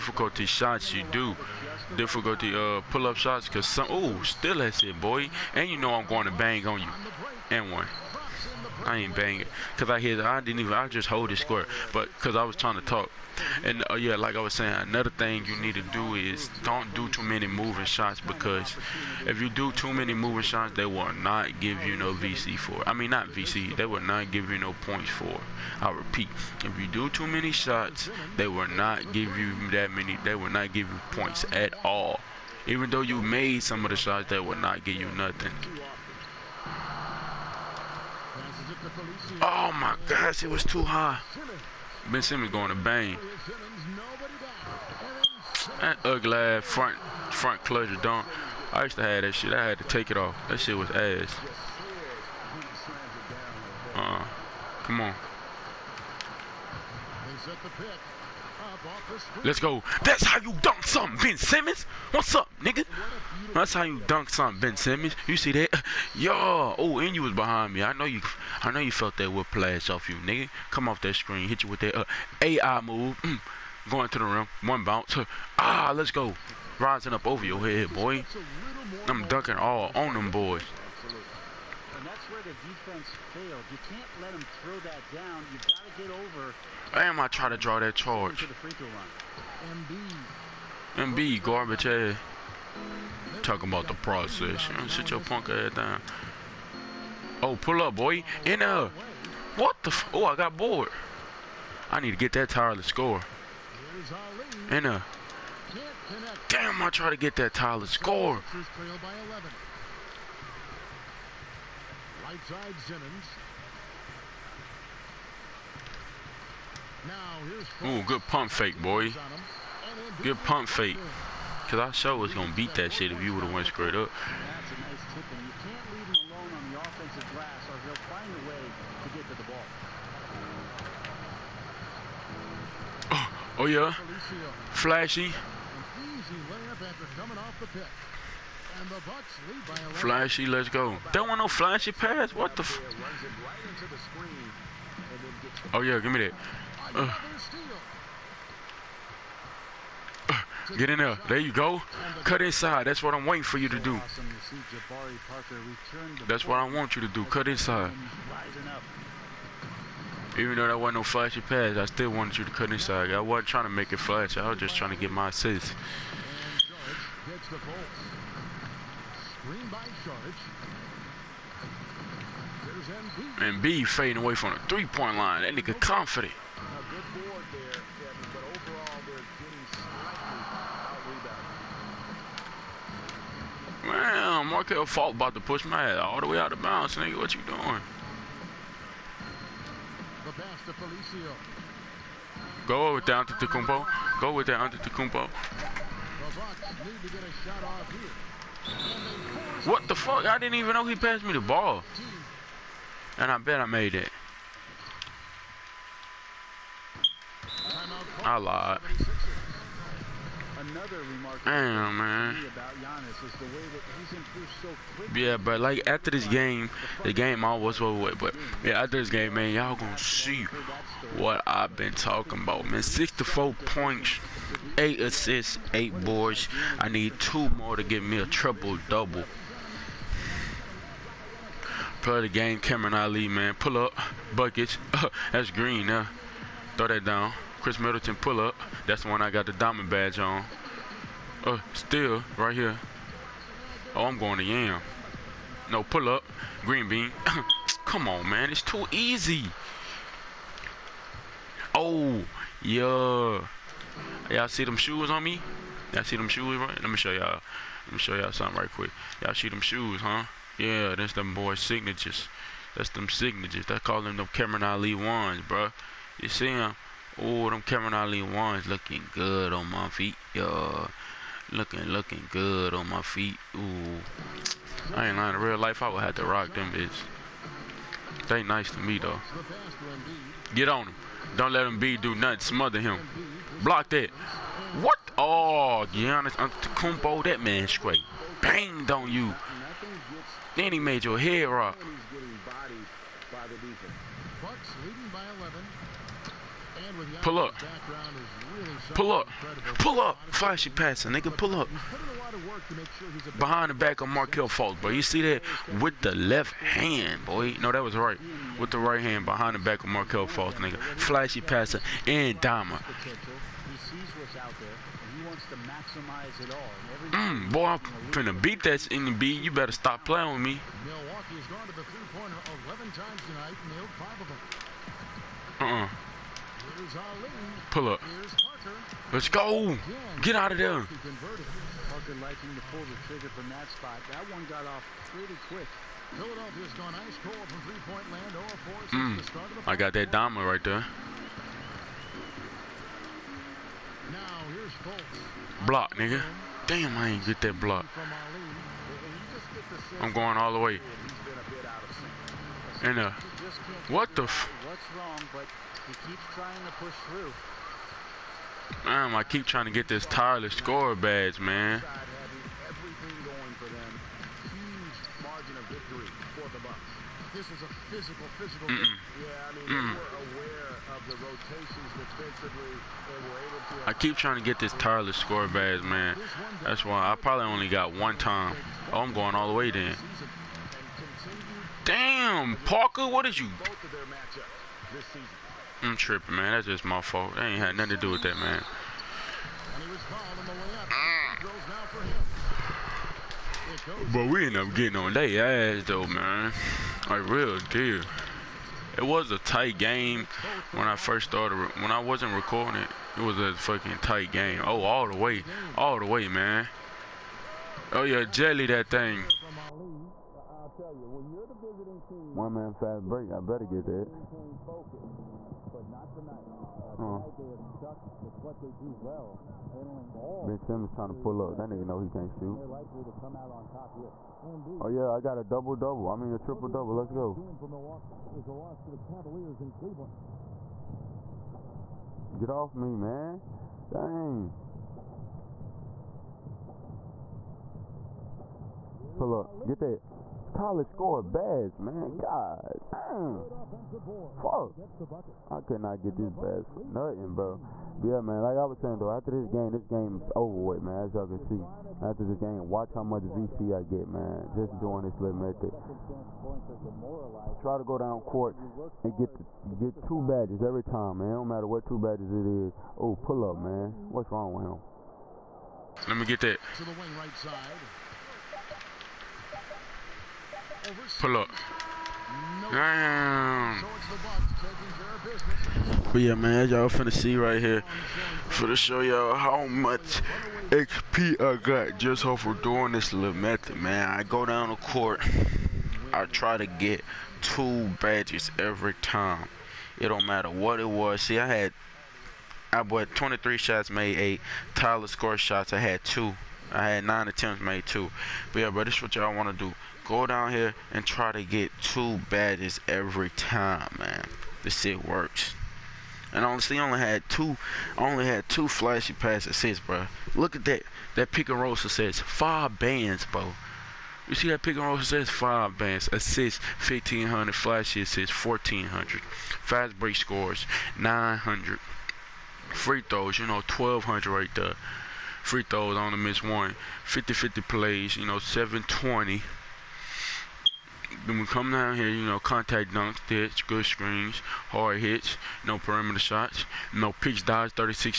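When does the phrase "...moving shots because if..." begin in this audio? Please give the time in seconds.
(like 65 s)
17 s.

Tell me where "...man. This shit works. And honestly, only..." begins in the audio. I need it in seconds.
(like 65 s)
503 s.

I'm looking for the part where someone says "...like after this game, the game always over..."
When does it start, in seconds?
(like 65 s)
215 s.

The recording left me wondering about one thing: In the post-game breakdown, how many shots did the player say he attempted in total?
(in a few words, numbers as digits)
23.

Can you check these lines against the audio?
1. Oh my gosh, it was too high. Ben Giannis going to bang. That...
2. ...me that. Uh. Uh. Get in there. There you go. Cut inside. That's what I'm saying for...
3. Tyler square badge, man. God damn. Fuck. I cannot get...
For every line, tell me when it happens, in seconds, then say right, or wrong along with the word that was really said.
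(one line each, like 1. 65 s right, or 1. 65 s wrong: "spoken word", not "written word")
1. 39 s wrong: "Simmons", not "Giannis"
2. 146 s wrong: "waiting", not "saying"
3. 440 s wrong: "score", not "square".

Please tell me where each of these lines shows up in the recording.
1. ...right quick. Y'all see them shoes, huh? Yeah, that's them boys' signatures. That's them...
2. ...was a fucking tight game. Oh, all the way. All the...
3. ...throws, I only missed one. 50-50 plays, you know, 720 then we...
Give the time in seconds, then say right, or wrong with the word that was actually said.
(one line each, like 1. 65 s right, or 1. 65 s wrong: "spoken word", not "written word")
1. 258 s right
2. 403 s right
3. 525 s right.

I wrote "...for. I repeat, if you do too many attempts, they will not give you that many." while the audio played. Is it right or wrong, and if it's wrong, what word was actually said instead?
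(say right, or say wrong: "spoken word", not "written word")
wrong: "shots", not "attempts".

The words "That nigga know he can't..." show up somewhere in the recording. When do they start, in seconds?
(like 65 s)
421 s.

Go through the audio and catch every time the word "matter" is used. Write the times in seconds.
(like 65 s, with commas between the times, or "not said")
461 s, 490 s.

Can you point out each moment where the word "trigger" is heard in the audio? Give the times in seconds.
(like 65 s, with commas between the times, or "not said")
333 s.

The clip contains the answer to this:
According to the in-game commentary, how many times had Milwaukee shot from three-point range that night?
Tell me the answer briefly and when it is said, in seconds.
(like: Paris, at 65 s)
11, at 322 s.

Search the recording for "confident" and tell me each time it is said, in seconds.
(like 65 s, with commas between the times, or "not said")
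175 s.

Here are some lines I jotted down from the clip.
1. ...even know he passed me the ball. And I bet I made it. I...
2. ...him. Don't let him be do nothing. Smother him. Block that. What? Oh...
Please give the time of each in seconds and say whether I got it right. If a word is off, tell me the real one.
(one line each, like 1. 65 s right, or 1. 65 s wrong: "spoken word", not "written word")
1. 200 s right
2. 280 s right.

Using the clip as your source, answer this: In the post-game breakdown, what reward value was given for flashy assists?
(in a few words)
1,400.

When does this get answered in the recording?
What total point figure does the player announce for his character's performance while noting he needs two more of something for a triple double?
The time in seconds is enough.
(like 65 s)
222 s.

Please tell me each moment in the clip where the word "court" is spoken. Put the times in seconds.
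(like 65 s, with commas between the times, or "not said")
458 s, 484 s.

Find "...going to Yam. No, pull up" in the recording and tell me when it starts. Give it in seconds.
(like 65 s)
244 s.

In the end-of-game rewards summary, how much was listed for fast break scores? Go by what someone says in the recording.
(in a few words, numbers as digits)
900.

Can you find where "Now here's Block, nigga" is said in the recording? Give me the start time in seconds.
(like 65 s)
344 s.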